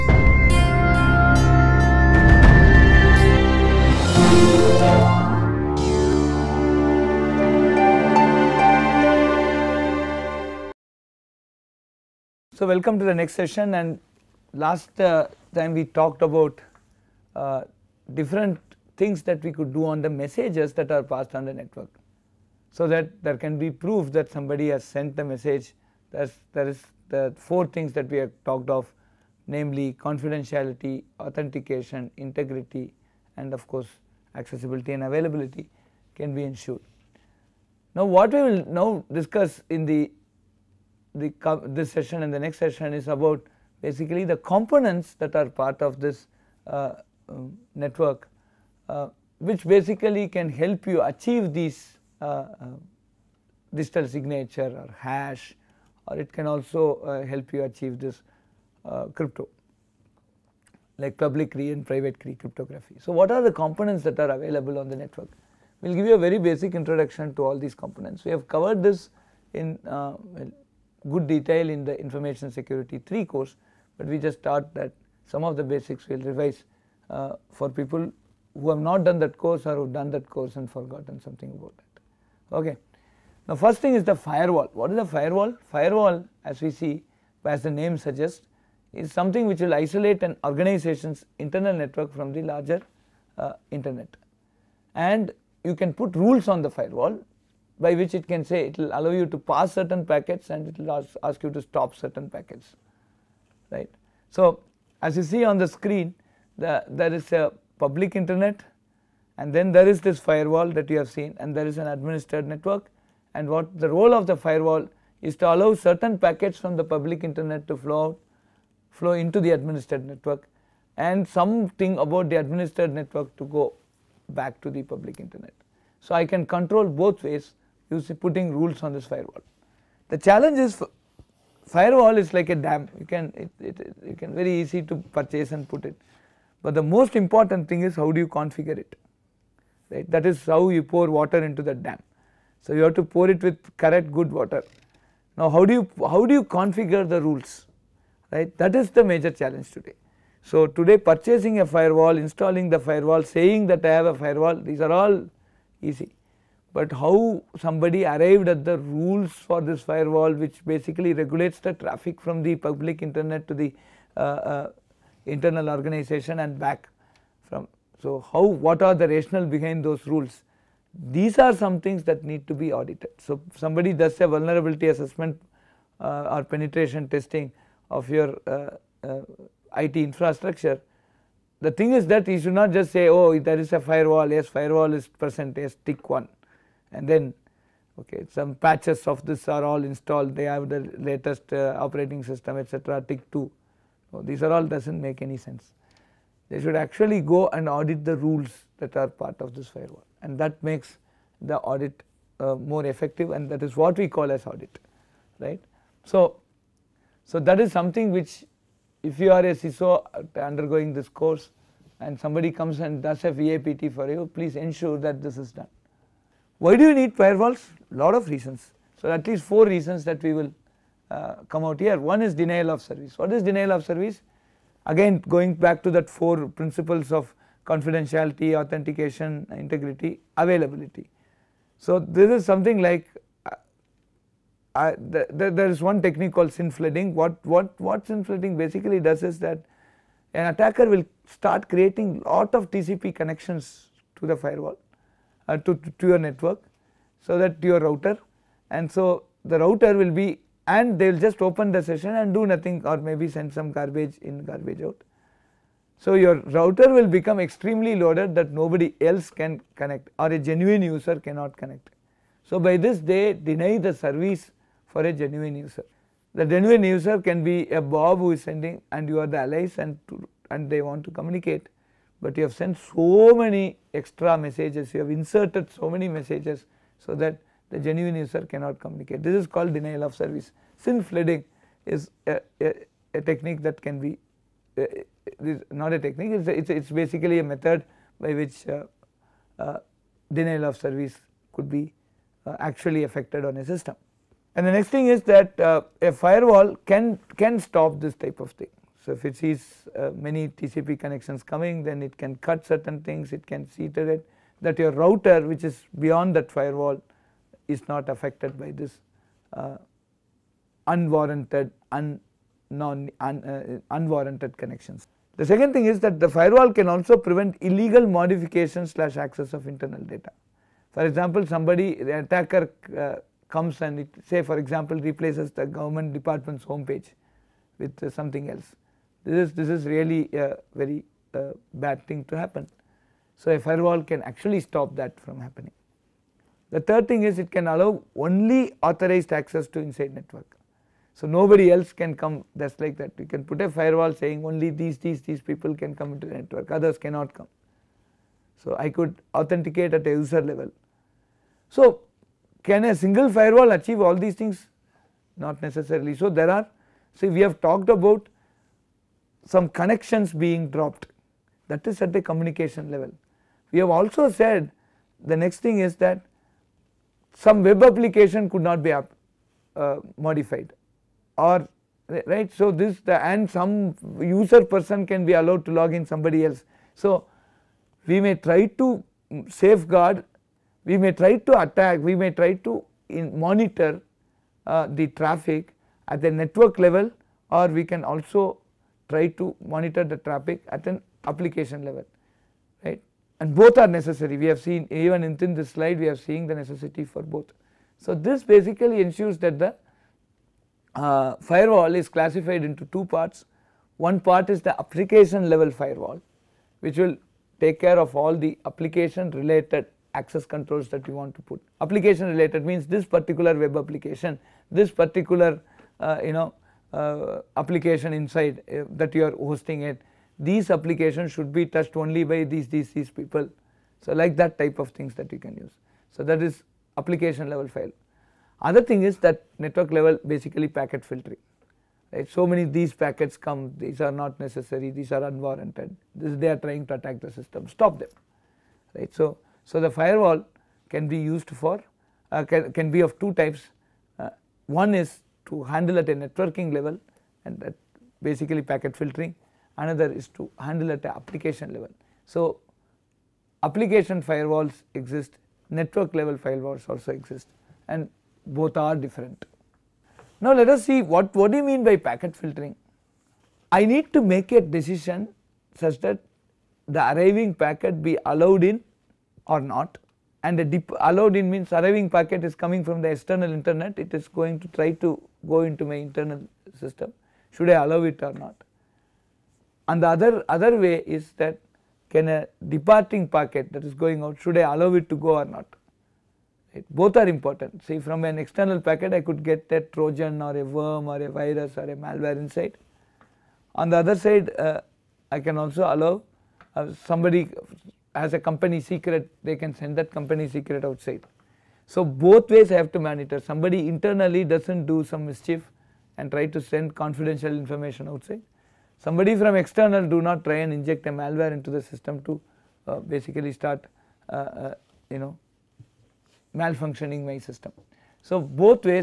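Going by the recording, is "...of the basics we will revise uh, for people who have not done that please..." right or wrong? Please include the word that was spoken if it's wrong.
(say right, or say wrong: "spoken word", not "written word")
wrong: "course", not "please".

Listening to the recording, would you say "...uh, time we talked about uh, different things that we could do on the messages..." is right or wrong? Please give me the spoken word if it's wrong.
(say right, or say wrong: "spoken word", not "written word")
right.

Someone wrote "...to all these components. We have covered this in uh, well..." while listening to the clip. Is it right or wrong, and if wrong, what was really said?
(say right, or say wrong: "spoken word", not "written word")
right.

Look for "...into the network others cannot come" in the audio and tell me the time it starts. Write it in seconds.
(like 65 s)
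346 s.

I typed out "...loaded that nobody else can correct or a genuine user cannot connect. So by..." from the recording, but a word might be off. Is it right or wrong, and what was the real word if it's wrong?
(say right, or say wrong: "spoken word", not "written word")
wrong: "connect", not "correct".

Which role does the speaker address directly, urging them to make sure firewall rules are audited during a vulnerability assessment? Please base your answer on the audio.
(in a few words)
CISO.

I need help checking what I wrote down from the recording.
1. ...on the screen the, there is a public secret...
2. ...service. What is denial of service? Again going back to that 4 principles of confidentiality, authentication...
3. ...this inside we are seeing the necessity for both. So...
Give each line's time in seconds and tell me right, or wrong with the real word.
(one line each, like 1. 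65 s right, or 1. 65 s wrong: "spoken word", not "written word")
1. 105 s wrong: "internet", not "secret"
2. 222 s right
3. 395 s wrong: "slide", not "inside".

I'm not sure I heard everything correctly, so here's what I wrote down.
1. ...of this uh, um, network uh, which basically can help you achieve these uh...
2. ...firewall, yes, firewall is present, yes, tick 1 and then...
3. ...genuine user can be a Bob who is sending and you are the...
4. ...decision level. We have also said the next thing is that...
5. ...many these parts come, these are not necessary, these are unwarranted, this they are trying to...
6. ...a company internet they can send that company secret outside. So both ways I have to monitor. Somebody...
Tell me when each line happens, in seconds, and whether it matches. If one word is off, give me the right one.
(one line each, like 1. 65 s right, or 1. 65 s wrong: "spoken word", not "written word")
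1. 45 s right
2. 183 s right
3. 266 s right
4. 362 s wrong: "communication", not "decision"
5. 432 s wrong: "packets", not "parts"
6. 498 s wrong: "secret", not "internet".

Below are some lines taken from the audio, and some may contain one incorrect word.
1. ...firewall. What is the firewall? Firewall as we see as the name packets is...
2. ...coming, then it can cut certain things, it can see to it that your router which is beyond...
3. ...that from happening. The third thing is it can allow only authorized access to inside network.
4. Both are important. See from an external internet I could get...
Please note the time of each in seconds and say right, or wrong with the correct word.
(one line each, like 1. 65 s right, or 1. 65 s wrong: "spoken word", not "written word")
1. 84 s wrong: "suggests", not "packets"
2. 301 s right
3. 334 s right
4. 486 s wrong: "packet", not "internet".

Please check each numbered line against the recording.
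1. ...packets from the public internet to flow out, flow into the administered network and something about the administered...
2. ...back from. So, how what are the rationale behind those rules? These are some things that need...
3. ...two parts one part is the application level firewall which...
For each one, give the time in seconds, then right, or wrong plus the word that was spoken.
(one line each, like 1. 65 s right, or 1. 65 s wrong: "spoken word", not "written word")
1. 116 s right
2. 166 s right
3. 402 s right.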